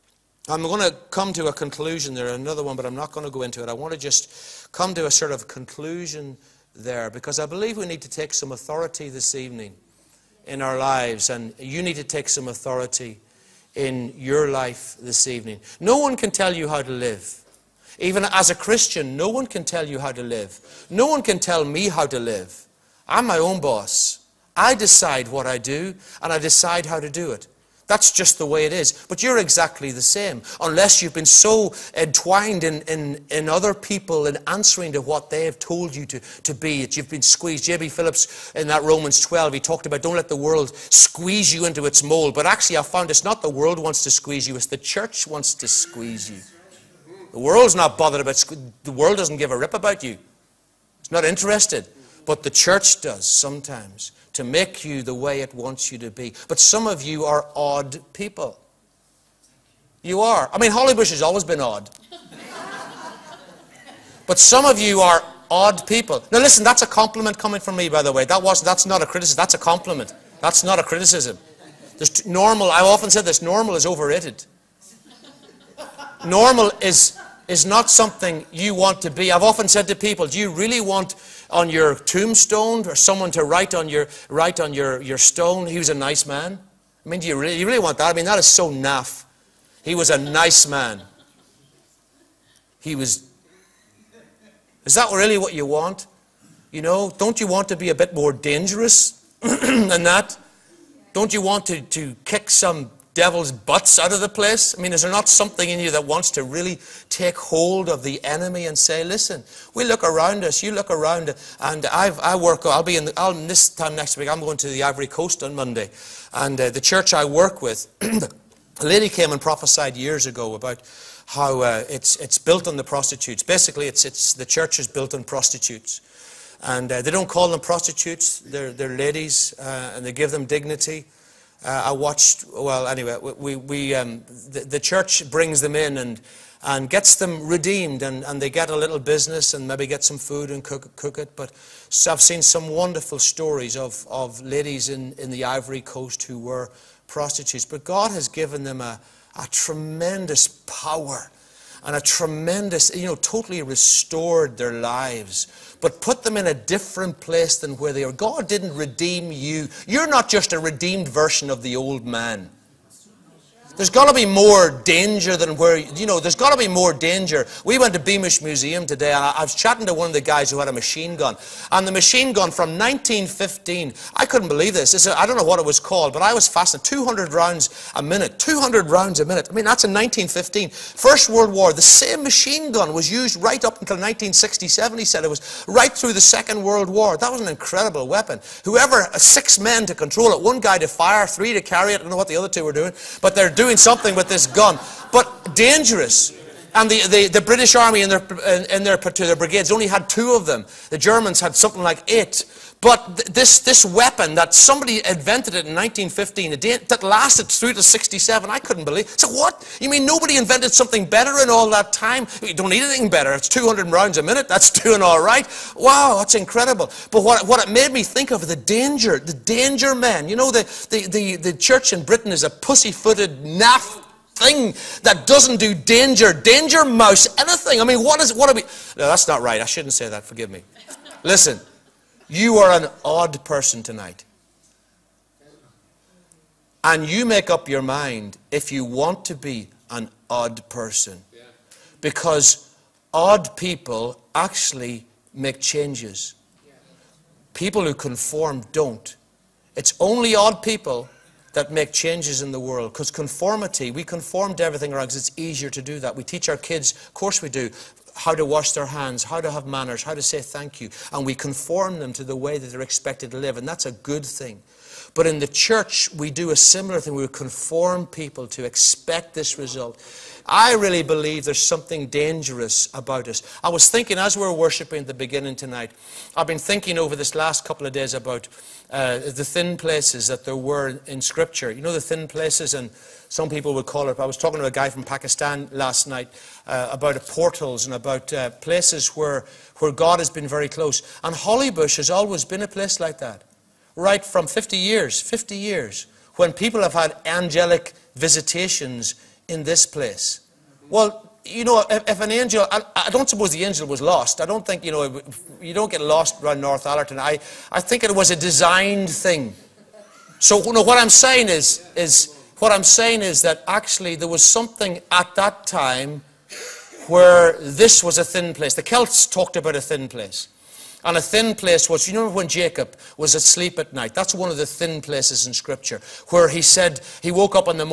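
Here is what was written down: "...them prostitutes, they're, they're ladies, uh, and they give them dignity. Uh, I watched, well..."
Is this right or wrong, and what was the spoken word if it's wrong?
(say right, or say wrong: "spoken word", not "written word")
right.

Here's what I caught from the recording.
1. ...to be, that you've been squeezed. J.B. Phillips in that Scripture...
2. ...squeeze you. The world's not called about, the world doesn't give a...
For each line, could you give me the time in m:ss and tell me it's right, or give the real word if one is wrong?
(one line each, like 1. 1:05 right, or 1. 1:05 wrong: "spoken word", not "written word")
1. 0:36 wrong: "Romans", not "Scripture"
2. 0:45 wrong: "bothered", not "called".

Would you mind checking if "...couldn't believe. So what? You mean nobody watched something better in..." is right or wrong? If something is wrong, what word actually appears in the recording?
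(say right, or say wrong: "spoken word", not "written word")
wrong: "invented", not "watched".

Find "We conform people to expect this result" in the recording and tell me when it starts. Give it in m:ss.
4:27.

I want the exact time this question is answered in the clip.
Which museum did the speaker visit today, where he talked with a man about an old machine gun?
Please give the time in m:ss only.
2:47.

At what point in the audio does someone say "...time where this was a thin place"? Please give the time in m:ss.
5:15.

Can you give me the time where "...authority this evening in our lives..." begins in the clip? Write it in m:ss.
0:08.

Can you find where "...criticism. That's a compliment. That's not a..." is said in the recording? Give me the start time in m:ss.
1:09.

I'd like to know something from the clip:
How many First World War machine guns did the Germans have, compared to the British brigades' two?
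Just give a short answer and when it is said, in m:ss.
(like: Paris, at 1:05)
8, at 3:22.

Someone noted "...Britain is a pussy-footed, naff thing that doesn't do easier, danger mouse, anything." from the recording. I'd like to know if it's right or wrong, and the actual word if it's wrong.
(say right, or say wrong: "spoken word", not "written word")
wrong: "danger", not "easier".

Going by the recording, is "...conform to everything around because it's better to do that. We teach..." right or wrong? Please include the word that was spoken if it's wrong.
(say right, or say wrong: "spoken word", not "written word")
wrong: "easier", not "better".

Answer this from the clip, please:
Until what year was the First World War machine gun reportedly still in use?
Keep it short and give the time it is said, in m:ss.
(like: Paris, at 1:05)
1967, at 3:03.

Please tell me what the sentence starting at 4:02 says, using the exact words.
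Because odd people actually make changes.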